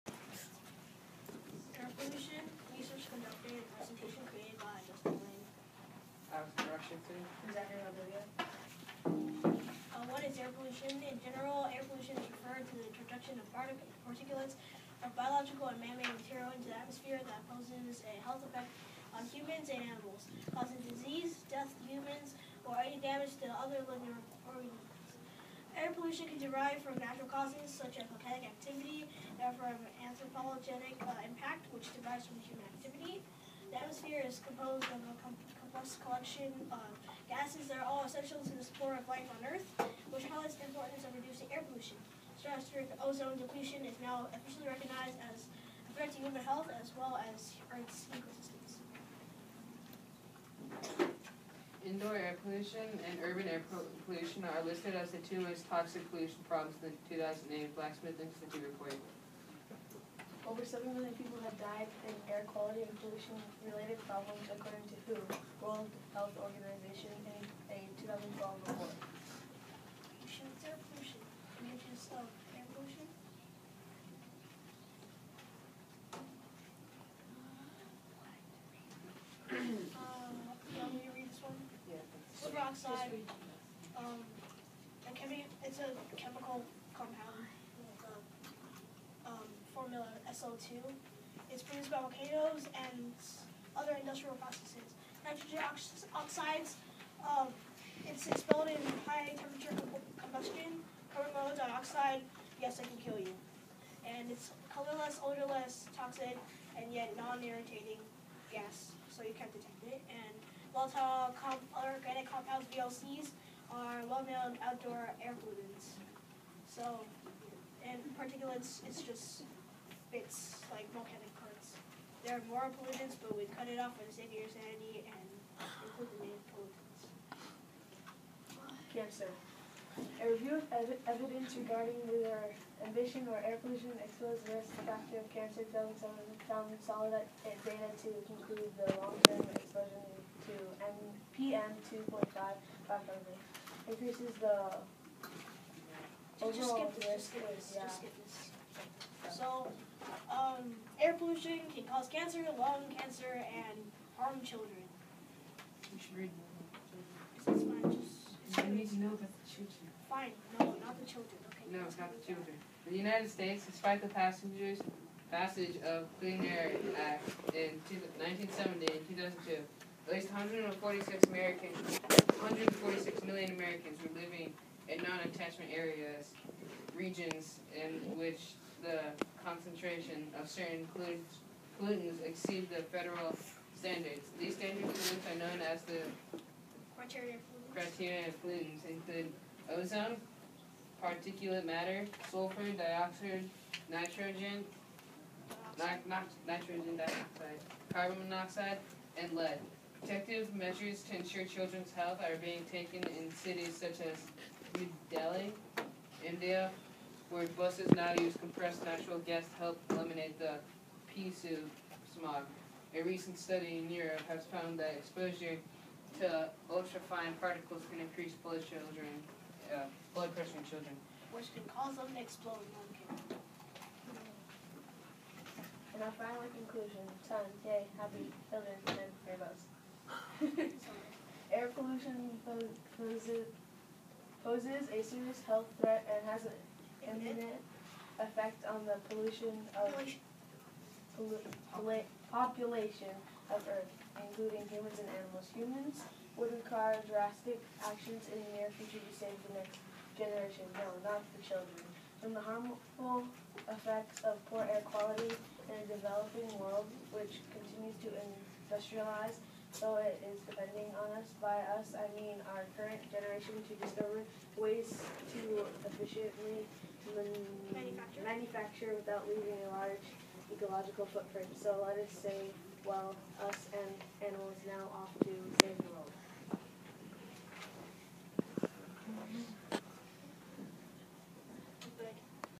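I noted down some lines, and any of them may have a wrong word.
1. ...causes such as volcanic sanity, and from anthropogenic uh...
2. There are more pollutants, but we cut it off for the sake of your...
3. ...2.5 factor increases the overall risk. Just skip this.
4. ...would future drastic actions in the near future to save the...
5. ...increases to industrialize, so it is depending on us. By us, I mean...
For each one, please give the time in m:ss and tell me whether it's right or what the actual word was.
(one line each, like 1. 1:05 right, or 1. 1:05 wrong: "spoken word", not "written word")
1. 0:27 wrong: "activity", not "sanity"
2. 2:02 right
3. 2:21 right
4. 4:06 wrong: "require", not "future"
5. 4:17 wrong: "continues", not "increases".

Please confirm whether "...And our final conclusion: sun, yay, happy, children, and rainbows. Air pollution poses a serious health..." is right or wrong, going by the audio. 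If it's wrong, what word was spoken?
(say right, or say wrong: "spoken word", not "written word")
right.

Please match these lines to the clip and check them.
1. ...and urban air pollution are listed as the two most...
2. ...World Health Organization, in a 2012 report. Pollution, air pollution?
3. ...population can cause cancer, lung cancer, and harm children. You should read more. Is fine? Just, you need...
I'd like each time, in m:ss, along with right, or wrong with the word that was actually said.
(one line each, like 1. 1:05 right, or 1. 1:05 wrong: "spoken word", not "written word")
1. 0:53 right
2. 1:05 right
3. 2:31 wrong: "pollution", not "population".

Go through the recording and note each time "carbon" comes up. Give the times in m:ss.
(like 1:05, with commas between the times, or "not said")
1:41, 3:17.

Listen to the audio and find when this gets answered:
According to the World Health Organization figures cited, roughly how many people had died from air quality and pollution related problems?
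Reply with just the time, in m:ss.
1:00.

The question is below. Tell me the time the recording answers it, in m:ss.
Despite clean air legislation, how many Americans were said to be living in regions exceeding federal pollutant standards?
2:52.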